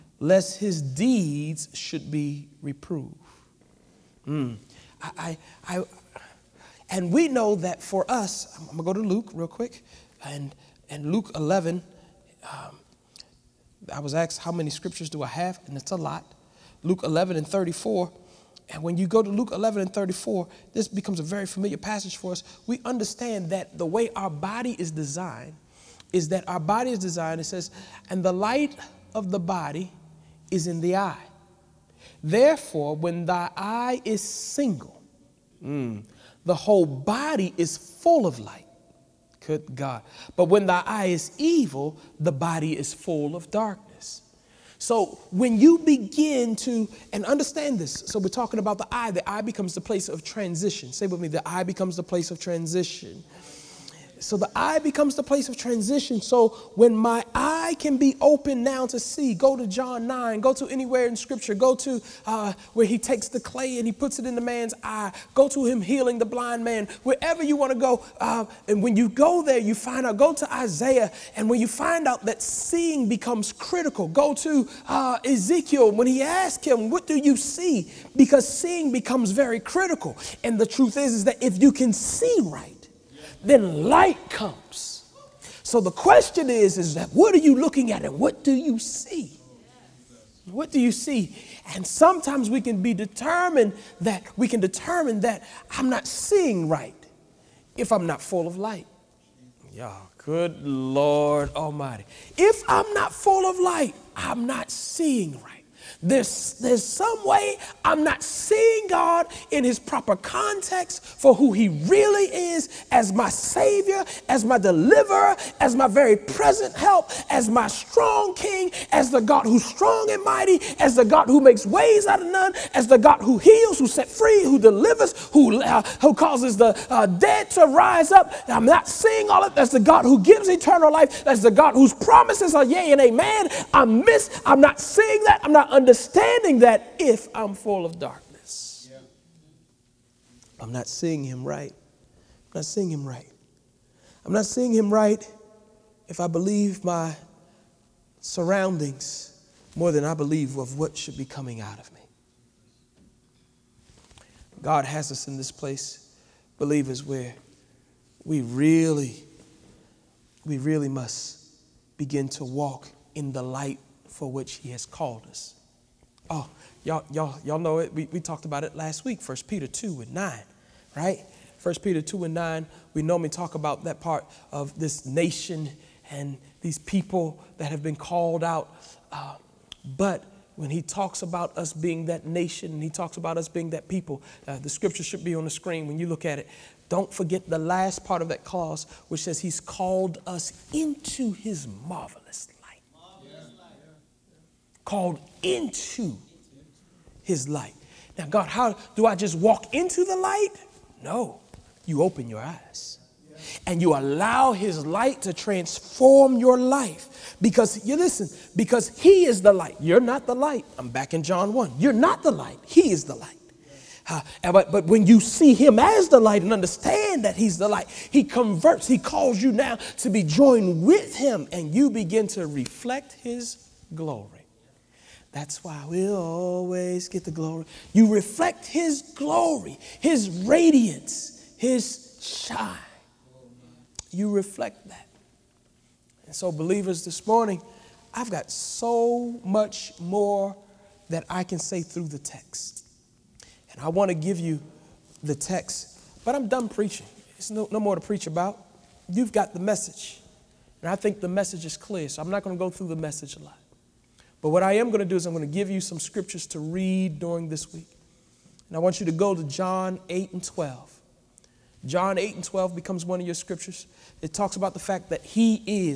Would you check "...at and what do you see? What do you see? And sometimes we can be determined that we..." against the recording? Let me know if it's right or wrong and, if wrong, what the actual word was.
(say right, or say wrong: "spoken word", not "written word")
right.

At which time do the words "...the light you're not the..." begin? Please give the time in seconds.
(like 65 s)
209 s.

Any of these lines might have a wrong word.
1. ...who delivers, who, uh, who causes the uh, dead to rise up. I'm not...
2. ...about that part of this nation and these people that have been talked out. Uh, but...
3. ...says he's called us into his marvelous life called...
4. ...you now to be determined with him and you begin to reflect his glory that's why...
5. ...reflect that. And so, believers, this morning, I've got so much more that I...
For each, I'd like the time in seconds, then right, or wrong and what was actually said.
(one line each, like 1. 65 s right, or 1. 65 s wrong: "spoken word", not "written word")
1. 124 s right
2. 173 s wrong: "called", not "talked"
3. 189 s right
4. 219 s wrong: "joined", not "determined"
5. 234 s right.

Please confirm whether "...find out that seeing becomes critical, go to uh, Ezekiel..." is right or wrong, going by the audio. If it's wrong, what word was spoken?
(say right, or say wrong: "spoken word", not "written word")
right.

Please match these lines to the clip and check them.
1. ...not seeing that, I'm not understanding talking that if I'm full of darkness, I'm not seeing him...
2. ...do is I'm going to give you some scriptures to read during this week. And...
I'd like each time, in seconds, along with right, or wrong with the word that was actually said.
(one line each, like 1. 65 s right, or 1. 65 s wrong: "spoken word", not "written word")
1. 134 s wrong: "understanding", not "talking"
2. 255 s right.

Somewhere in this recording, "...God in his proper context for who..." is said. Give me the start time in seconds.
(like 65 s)
108 s.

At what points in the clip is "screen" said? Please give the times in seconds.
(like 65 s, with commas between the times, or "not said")
185 s.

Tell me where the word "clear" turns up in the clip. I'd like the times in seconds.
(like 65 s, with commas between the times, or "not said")
251 s.